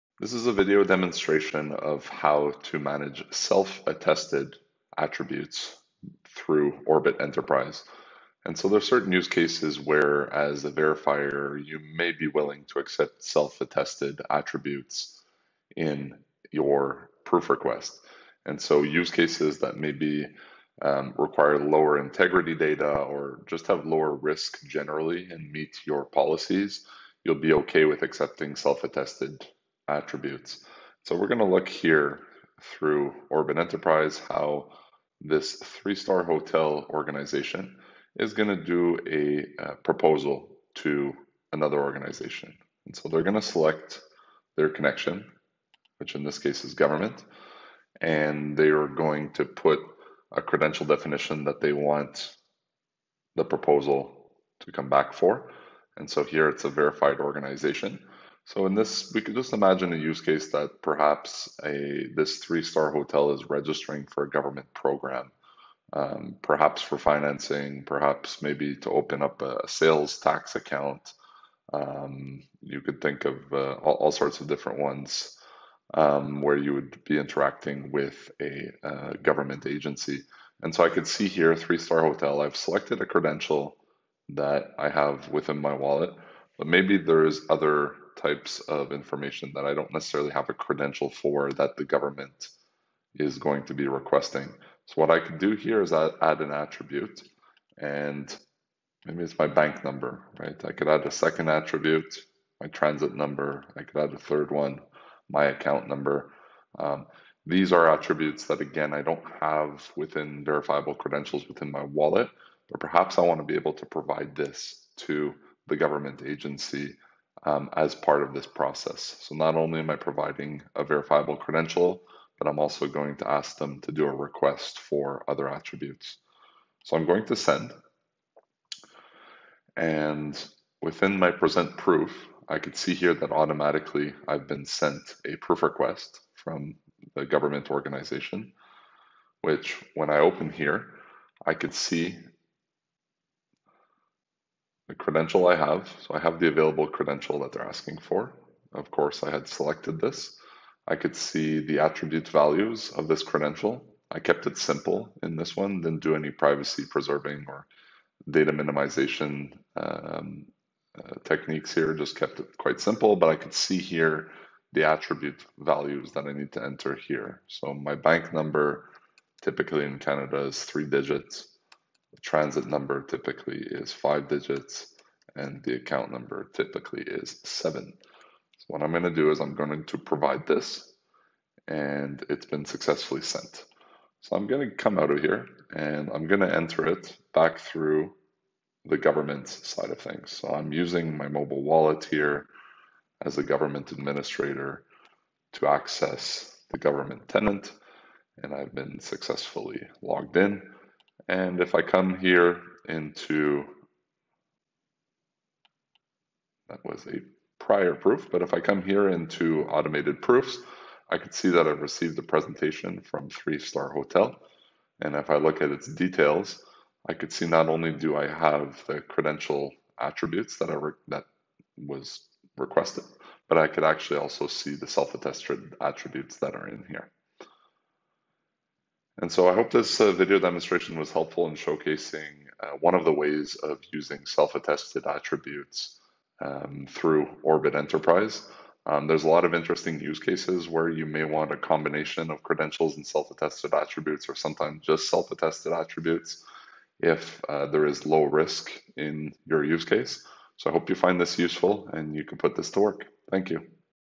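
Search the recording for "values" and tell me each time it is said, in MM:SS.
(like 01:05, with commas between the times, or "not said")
02:32, 02:45.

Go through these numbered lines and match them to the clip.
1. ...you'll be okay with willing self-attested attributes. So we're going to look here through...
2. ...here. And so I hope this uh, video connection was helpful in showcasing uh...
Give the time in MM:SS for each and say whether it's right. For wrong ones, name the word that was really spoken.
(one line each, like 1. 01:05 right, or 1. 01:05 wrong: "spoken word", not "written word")
1. 00:27 wrong: "accepting", not "willing"
2. 03:46 wrong: "demonstration", not "connection".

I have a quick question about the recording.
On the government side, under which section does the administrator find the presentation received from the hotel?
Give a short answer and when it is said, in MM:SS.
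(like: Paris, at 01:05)
Automated proofs, at 03:29.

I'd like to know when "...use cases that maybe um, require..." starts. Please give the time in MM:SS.
00:18.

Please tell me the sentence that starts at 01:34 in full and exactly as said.
So what I can do here is add, add an attribute and maybe it's my bank number, right?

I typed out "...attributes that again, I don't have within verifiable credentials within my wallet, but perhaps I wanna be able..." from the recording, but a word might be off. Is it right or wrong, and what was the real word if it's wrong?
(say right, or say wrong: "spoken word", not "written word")
right.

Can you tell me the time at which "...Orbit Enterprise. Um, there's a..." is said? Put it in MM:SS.
03:57.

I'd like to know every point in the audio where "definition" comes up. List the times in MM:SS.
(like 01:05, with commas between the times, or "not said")
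00:50.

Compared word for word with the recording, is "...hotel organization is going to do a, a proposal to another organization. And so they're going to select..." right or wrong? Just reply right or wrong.
right.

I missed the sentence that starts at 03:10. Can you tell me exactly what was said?
So I'm using my mobile wallet here as a government administrator to access the government tenant and I've been successfully logged in.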